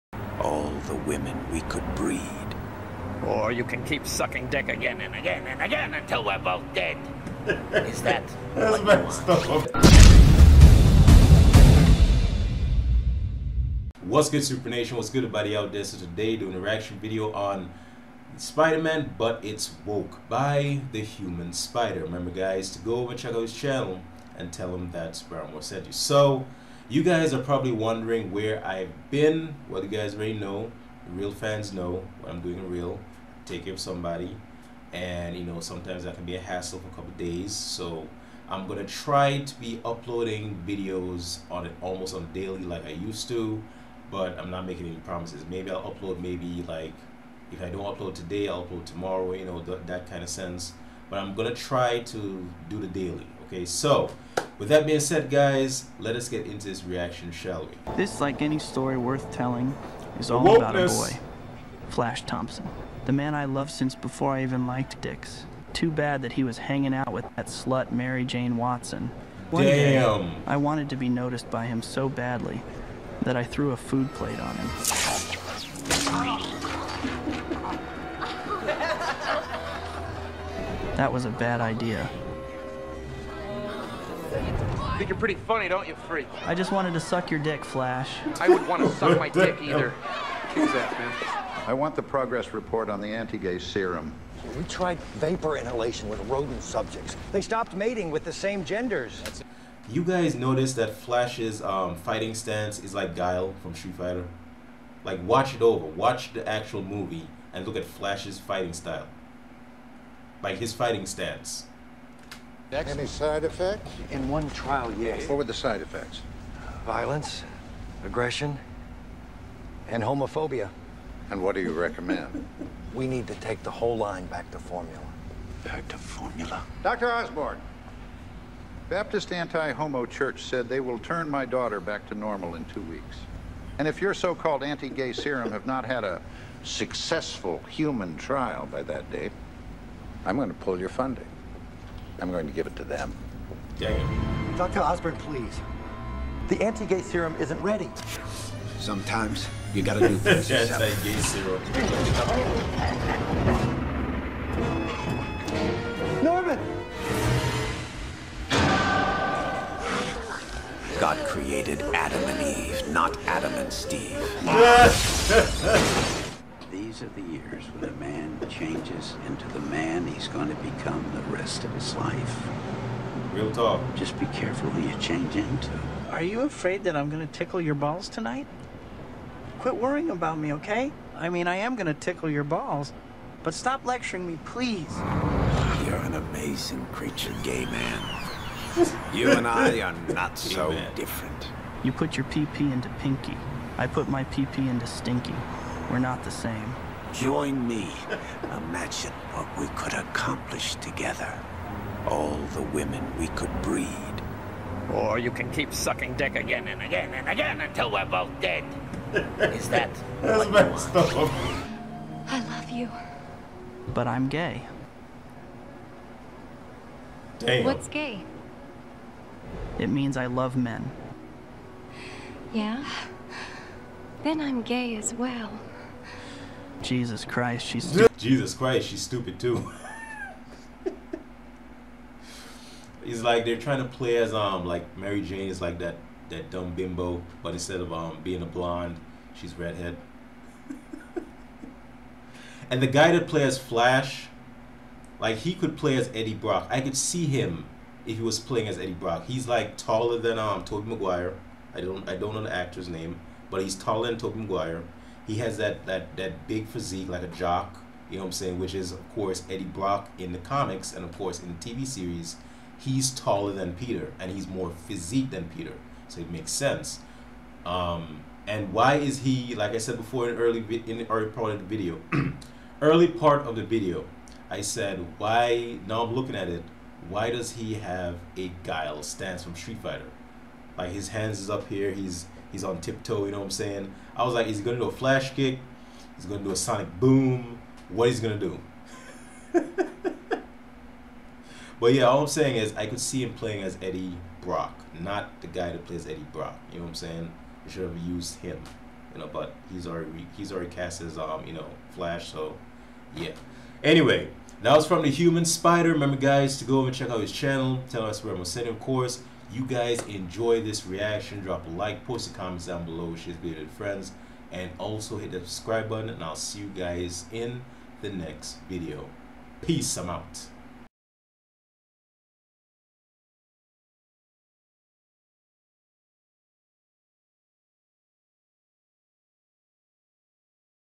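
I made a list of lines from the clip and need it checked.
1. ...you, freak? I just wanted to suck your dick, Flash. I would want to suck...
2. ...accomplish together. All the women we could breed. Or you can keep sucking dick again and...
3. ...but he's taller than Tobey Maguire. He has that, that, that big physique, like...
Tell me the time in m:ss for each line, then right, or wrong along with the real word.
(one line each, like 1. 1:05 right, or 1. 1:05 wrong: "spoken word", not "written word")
1. 1:25 right
2. 3:19 right
3. 4:13 right.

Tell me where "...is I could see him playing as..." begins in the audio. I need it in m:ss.
4:52.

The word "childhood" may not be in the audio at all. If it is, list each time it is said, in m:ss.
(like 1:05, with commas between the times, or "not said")
not said.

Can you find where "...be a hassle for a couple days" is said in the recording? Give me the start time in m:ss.
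0:36.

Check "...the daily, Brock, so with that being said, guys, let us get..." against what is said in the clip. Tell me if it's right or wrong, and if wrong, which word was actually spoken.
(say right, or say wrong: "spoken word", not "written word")
wrong: "Okay", not "Brock".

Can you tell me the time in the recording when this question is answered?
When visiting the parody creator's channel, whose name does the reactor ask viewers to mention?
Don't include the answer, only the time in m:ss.
0:25.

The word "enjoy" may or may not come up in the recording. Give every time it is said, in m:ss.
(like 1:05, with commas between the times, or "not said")
5:10.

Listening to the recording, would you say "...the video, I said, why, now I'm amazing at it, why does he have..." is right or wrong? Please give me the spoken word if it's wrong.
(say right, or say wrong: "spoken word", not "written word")
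wrong: "looking", not "amazing".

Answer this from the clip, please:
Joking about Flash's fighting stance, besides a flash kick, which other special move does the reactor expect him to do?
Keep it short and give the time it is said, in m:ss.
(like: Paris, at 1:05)
Sonic boom, at 4:46.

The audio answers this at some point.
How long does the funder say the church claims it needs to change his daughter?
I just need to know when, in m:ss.
2:12.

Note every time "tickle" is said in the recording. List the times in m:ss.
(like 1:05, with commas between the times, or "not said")
2:57, 3:01.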